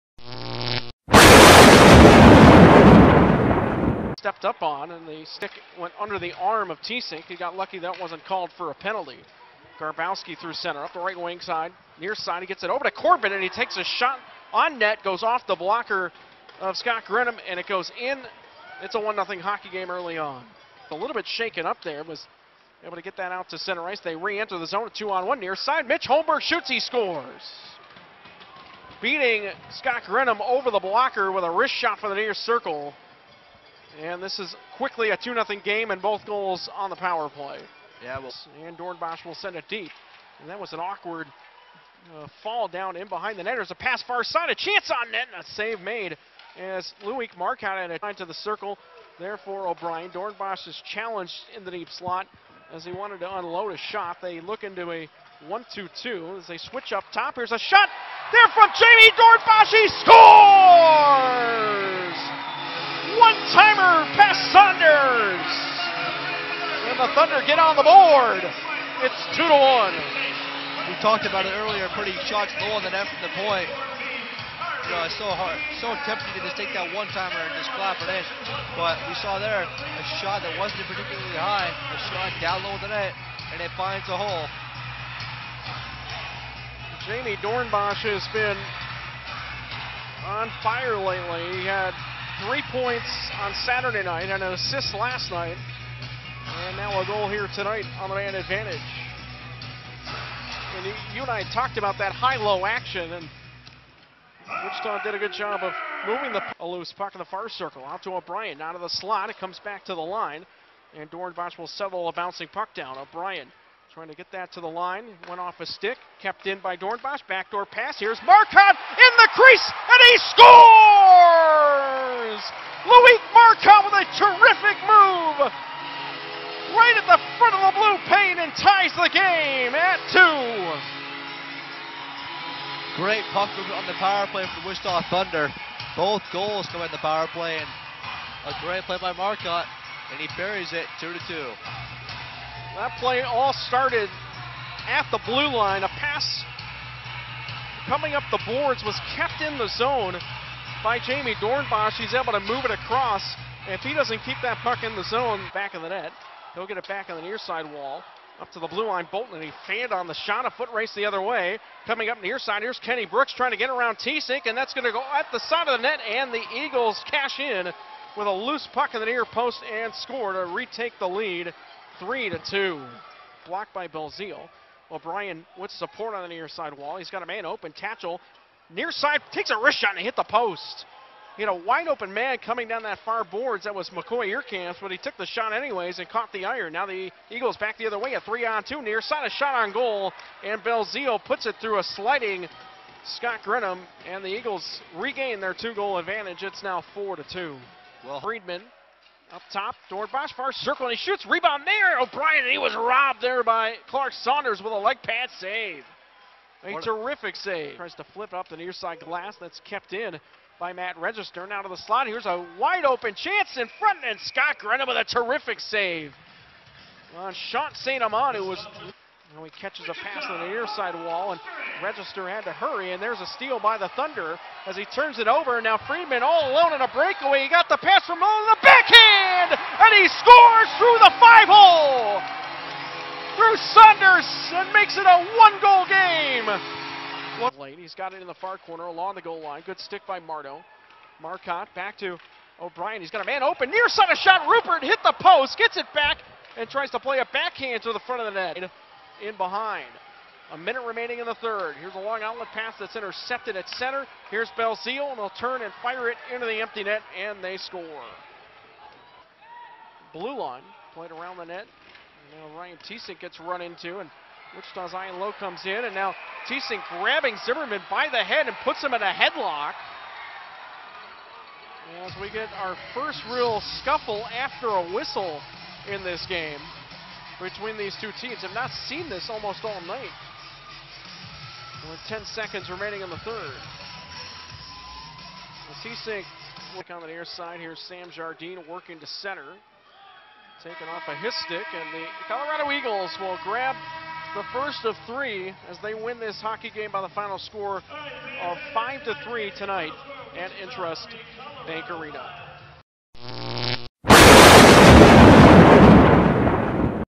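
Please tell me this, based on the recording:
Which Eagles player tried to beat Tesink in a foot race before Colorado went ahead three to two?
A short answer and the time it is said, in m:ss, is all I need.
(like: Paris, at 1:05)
Kenny Brooks, at 2:42.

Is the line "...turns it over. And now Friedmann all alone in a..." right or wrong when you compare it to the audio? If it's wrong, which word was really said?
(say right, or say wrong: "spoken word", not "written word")
right.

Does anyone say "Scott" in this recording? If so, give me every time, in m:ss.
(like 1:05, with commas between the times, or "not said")
0:16, 0:29, 3:13, 3:34.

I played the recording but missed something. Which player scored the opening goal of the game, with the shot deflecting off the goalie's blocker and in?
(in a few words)
Corbett.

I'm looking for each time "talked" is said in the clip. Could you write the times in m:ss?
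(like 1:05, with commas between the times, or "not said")
1:11, 1:41.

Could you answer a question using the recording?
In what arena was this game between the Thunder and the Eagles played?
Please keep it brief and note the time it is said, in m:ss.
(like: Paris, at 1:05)
INTRUST Bank Arena, at 5:00.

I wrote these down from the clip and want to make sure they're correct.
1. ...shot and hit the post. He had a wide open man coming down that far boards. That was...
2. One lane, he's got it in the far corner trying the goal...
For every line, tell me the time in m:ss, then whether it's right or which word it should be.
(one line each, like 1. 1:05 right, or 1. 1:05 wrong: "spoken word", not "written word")
1. 2:59 right
2. 3:57 wrong: "along", not "trying".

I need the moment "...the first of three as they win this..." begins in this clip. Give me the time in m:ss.
4:54.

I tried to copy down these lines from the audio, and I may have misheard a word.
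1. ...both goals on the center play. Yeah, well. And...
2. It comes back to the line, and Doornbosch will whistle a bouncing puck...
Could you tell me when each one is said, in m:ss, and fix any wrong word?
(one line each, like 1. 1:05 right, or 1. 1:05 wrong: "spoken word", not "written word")
1. 0:36 wrong: "power", not "center"
2. 1:49 wrong: "settle", not "whistle".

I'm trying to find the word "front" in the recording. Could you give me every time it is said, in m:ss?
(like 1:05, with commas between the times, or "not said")
2:07, 3:33, 4:08.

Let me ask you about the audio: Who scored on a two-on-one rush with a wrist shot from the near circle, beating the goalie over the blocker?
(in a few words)
Mitch Holmberg.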